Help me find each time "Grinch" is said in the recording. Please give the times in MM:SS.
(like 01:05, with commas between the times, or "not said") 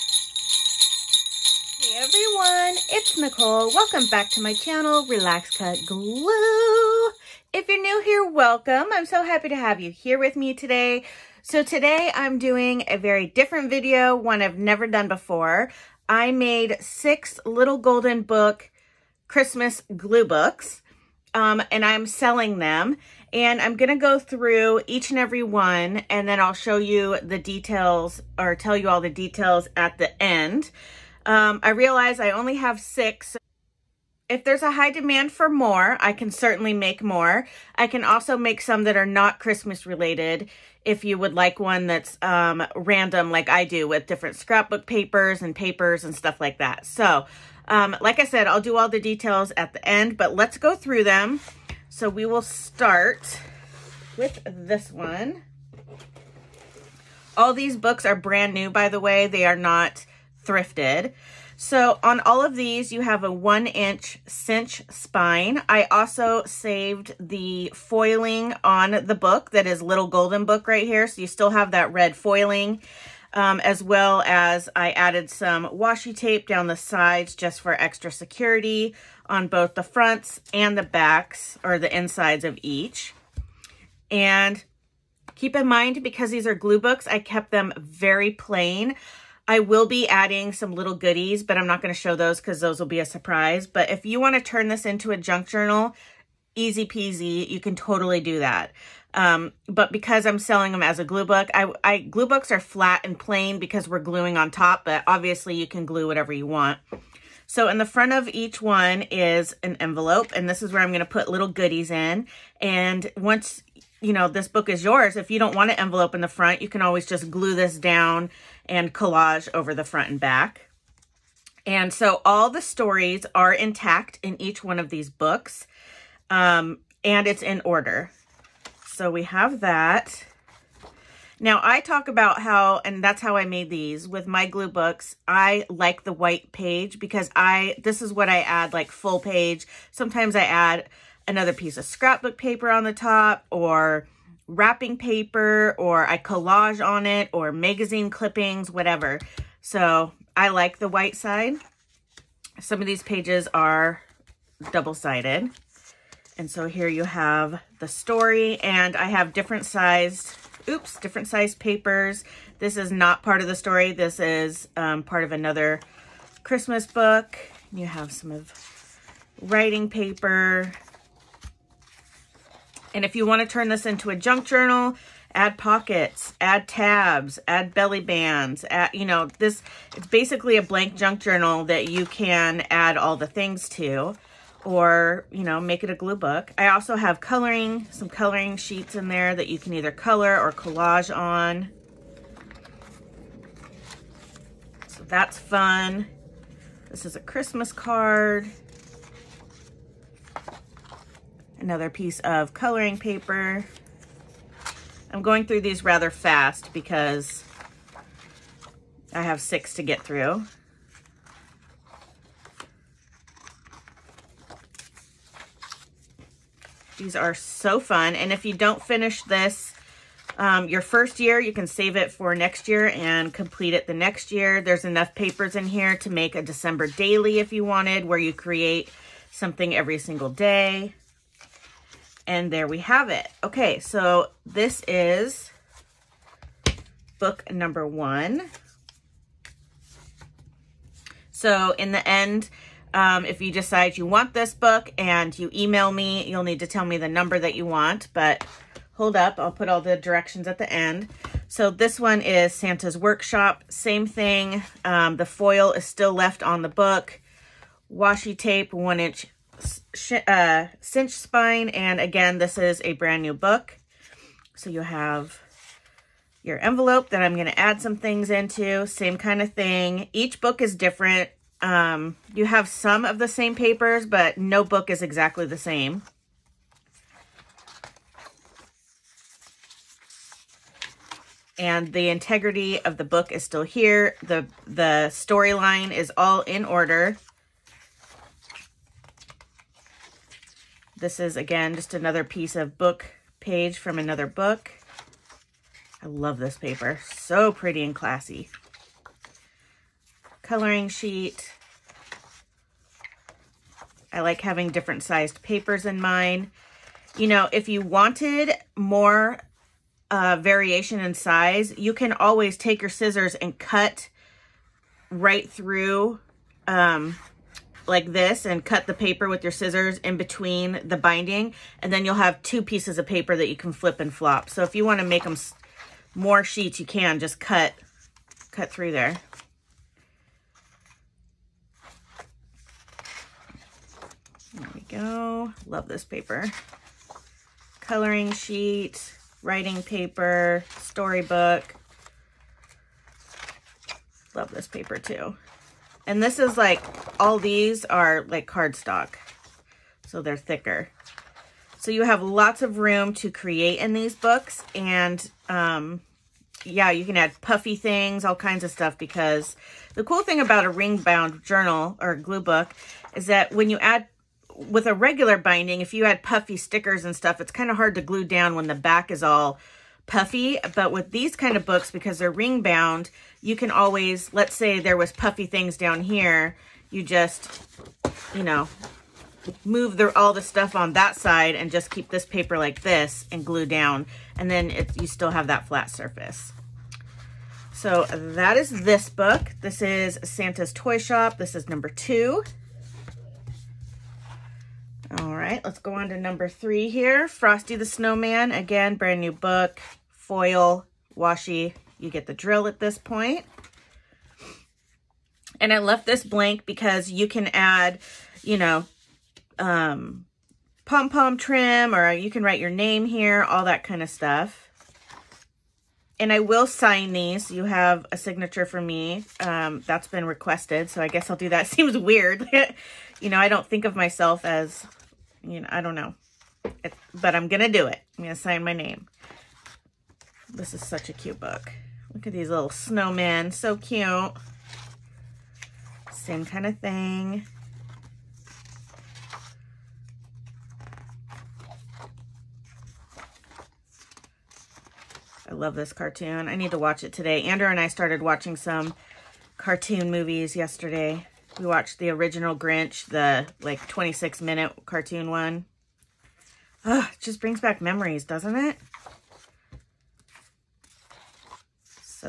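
07:32.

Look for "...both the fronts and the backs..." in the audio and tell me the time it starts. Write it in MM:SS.
01:19.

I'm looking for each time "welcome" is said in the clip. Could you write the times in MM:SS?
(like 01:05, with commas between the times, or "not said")
00:03, 00:08.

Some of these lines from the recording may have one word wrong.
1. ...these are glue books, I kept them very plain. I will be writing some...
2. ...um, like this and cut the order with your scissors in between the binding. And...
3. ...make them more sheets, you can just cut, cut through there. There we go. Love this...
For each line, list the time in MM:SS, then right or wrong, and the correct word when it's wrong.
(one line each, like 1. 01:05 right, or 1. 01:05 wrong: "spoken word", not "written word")
1. 01:26 wrong: "adding", not "writing"
2. 05:16 wrong: "paper", not "order"
3. 05:25 right.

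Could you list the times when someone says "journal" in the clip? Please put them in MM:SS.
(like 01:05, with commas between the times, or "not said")
01:35, 02:54, 03:01, 06:01.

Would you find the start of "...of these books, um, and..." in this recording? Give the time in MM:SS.
02:04.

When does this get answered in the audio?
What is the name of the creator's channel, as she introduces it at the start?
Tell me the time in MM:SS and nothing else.
00:05.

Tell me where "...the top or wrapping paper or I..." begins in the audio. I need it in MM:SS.
02:22.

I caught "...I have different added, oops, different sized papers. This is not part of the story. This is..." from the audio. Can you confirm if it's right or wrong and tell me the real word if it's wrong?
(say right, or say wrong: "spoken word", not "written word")
wrong: "sized", not "added".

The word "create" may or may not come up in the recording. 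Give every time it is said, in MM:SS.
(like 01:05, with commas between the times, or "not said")
03:48, 05:53.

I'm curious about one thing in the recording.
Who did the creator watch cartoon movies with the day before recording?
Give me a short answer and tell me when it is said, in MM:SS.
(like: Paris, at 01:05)
Andrew, at 07:27.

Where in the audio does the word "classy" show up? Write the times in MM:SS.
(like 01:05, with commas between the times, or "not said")
04:57.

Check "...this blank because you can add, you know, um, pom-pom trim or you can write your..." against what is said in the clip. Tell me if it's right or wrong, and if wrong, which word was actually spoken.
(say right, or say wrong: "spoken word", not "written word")
right.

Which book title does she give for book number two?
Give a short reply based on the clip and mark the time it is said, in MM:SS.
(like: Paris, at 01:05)
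Santa's Toy Shop, at 06:30.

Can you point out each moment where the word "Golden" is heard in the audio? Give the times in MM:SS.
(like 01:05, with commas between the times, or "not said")
00:17, 01:10.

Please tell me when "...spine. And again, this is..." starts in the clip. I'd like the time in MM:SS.
04:21.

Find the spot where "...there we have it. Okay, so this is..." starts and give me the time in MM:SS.
03:52.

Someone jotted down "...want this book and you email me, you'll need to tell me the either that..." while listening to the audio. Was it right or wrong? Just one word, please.
wrong.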